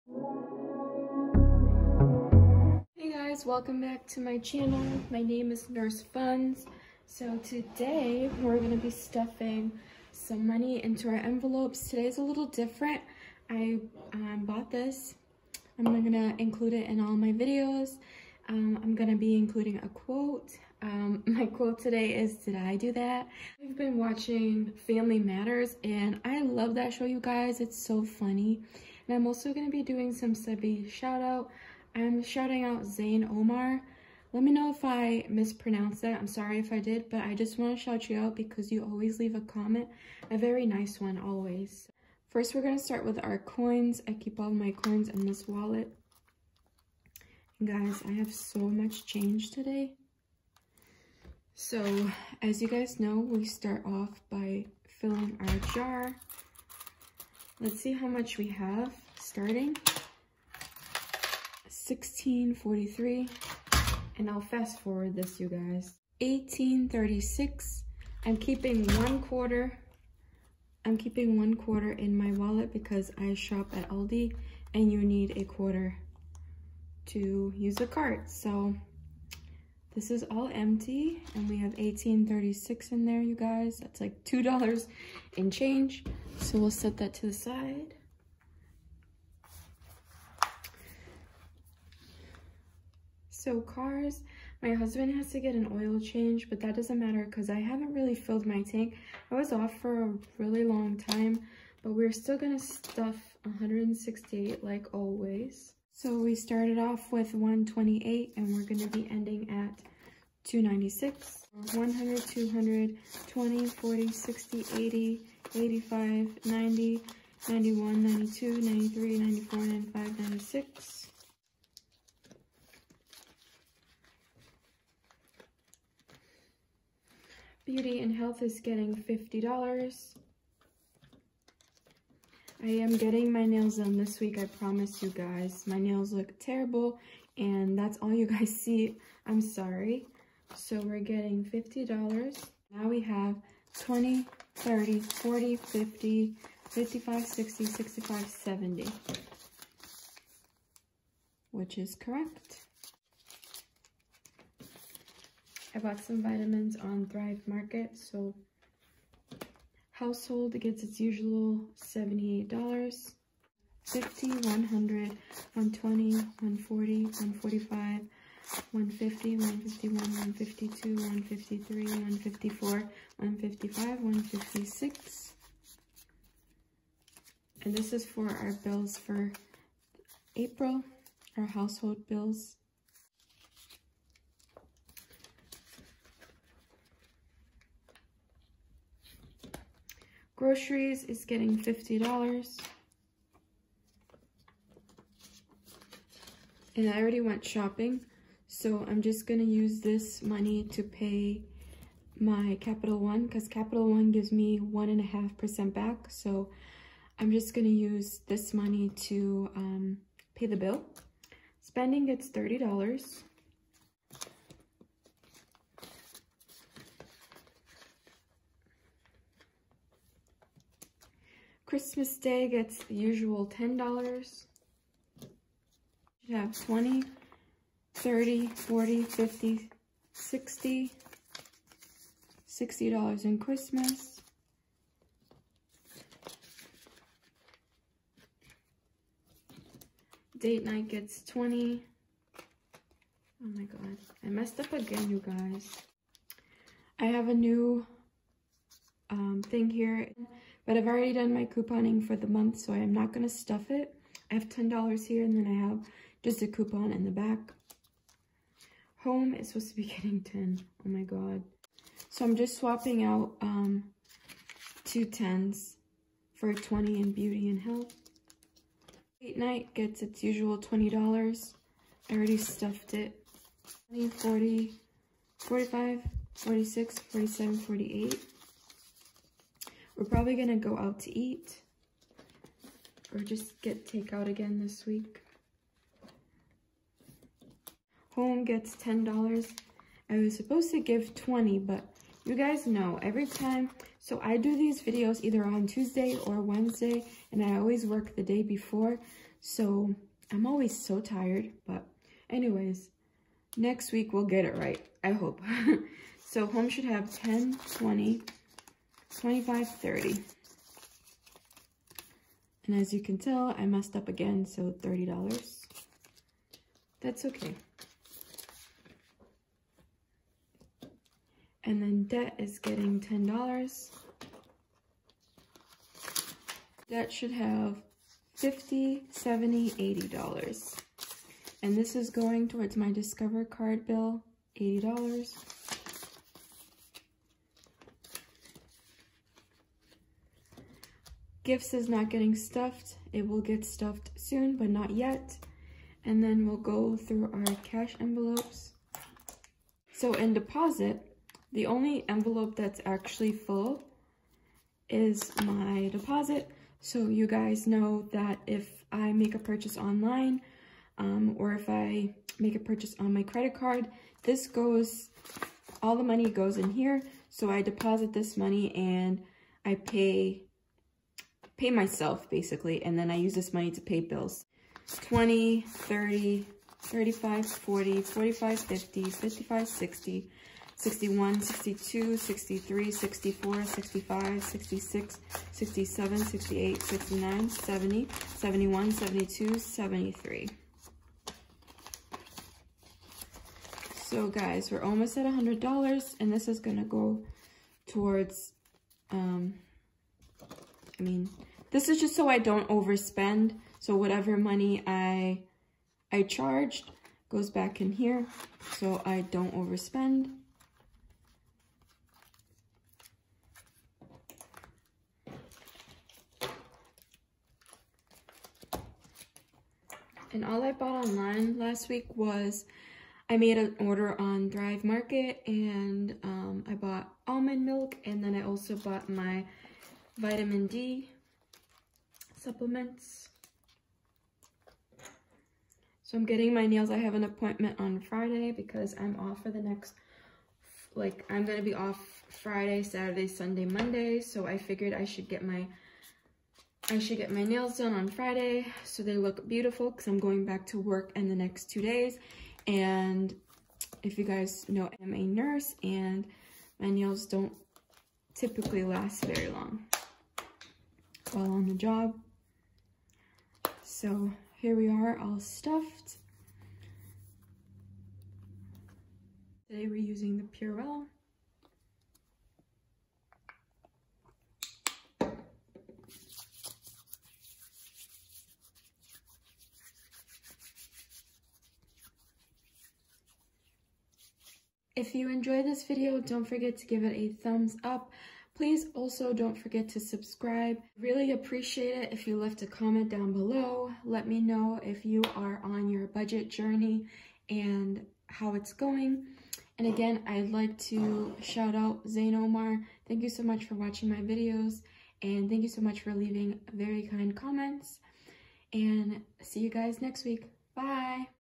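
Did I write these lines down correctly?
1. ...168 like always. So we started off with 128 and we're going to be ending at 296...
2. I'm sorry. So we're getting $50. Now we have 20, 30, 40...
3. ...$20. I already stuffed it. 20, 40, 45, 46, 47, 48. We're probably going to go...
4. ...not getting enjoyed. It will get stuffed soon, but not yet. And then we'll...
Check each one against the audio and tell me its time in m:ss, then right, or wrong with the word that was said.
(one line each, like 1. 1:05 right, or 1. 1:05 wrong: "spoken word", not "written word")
1. 1:43 right
2. 2:19 right
3. 4:30 right
4. 5:41 wrong: "stuffed", not "enjoyed".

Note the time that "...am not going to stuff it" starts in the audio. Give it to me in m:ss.
4:12.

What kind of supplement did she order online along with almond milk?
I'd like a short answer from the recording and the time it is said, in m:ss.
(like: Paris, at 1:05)
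vitamin D, at 7:10.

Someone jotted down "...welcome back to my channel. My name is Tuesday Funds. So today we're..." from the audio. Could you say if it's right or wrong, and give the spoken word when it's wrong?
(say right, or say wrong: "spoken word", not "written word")
wrong: "Nurse", not "Tuesday".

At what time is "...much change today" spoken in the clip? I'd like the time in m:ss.
0:48.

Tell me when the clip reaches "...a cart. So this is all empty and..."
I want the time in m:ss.
1:17.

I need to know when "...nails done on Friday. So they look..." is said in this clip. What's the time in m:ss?
7:27.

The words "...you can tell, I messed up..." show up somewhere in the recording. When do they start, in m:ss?
5:12.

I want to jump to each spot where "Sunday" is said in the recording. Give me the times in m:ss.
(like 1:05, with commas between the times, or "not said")
7:23.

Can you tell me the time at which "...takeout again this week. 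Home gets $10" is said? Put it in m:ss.
4:43.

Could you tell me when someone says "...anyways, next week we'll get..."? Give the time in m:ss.
5:02.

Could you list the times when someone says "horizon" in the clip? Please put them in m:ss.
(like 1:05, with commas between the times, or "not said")
not said.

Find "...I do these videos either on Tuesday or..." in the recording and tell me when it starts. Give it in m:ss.
4:54.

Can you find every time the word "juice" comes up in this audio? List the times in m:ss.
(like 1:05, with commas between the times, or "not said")
not said.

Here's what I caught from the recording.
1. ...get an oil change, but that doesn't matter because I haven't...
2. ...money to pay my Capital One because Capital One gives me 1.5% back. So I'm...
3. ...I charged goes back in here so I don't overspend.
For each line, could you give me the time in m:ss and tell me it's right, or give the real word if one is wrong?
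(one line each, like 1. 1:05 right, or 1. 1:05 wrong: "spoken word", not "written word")
1. 1:35 right
2. 3:20 right
3. 6:46 right.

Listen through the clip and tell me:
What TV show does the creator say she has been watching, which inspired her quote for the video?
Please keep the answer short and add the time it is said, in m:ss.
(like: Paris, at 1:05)
Family Matters, at 0:24.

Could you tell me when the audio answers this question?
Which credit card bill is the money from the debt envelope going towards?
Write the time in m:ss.
5:32.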